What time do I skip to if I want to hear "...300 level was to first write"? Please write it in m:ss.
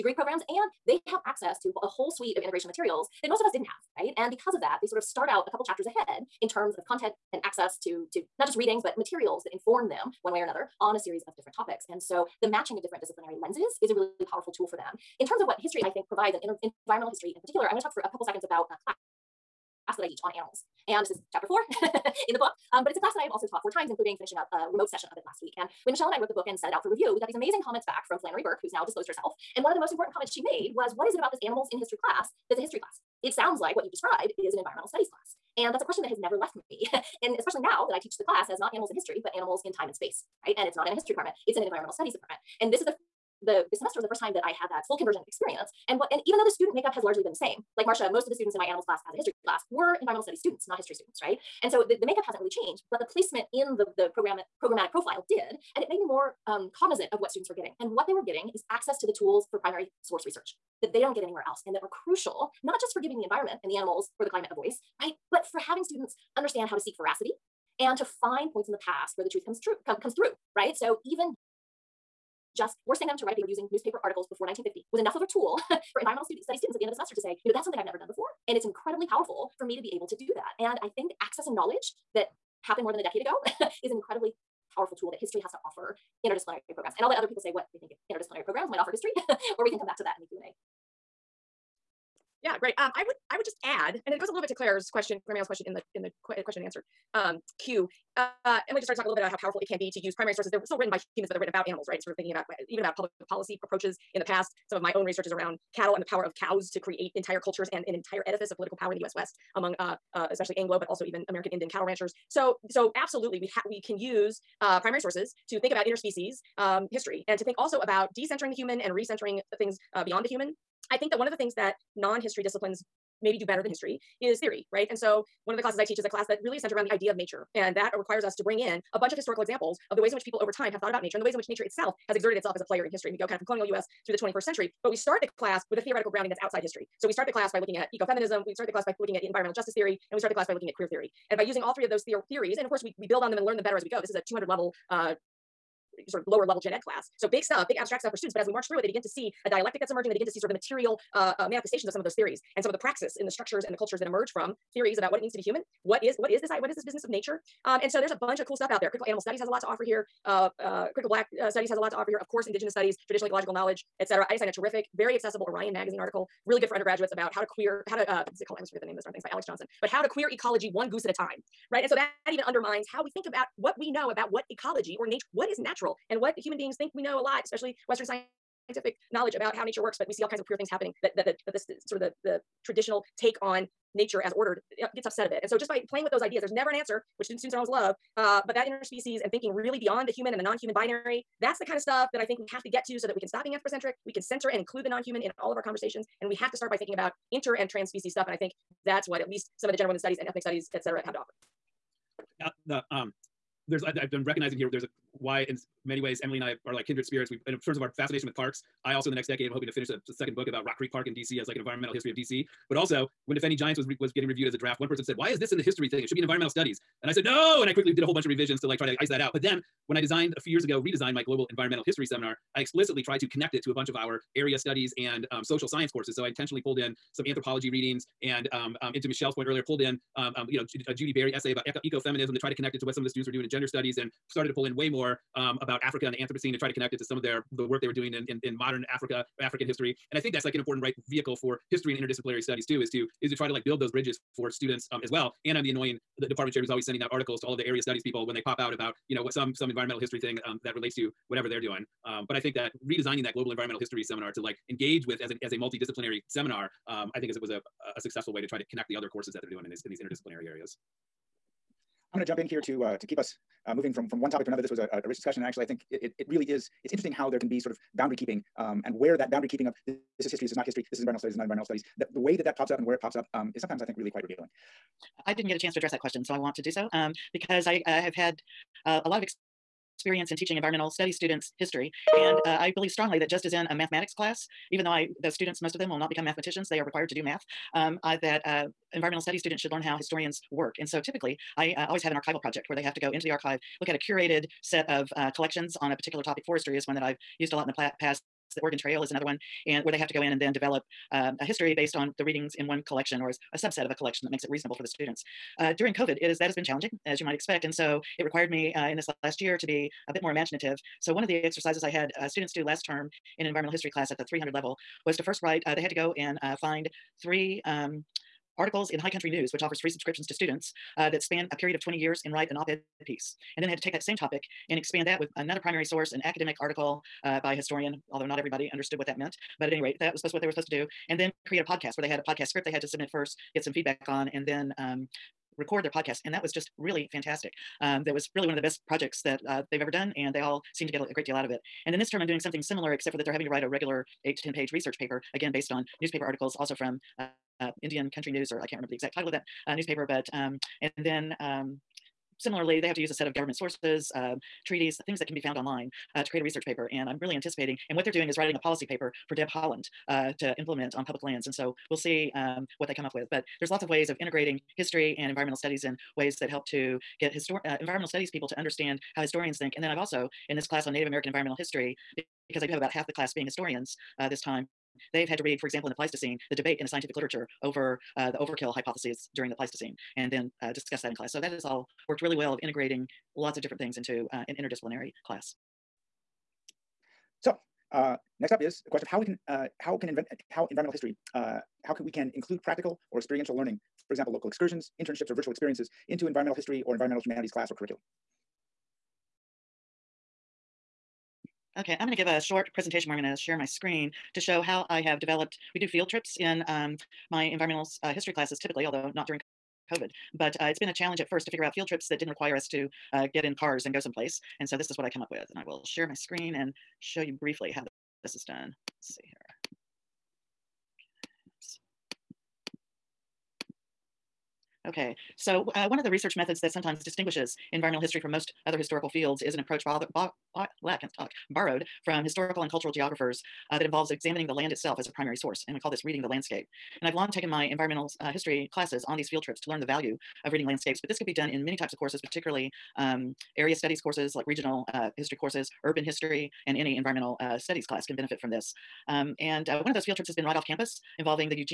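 5:14.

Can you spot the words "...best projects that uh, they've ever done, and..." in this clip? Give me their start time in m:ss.
5:38.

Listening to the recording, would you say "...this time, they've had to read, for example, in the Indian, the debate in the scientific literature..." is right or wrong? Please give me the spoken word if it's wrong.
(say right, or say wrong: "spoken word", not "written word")
wrong: "Pleistocene", not "Indian".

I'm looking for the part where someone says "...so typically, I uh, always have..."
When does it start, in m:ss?
4:50.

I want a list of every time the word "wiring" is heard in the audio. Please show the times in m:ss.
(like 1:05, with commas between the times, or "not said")
not said.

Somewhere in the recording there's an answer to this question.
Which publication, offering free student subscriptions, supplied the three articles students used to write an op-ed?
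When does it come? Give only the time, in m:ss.
5:18.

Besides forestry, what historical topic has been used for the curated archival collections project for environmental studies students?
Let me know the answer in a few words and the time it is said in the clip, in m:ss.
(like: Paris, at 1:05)
The Oregon Trail, at 4:58.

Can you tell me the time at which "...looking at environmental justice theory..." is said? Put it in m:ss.
2:18.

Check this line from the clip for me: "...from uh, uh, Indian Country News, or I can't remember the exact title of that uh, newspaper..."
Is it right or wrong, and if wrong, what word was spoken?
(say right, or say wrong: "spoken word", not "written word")
right.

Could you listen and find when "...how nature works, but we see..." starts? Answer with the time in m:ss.
2:59.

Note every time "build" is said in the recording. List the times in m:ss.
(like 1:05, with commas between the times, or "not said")
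2:23, 4:03.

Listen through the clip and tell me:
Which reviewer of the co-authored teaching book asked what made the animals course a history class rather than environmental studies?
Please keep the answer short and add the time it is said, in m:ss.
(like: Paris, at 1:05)
Flannery Burke, at 0:28.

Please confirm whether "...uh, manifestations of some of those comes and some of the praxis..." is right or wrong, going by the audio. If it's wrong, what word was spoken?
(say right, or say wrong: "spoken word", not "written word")
wrong: "theories", not "comes".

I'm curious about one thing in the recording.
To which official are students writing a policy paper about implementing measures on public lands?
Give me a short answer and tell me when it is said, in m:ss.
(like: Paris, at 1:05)
Deb Haaland, at 5:59.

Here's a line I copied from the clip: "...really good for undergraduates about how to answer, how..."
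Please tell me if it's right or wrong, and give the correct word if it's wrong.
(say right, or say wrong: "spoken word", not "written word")
wrong: "queer", not "answer".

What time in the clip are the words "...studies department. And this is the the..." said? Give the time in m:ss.
0:41.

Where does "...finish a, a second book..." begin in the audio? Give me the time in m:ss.
3:29.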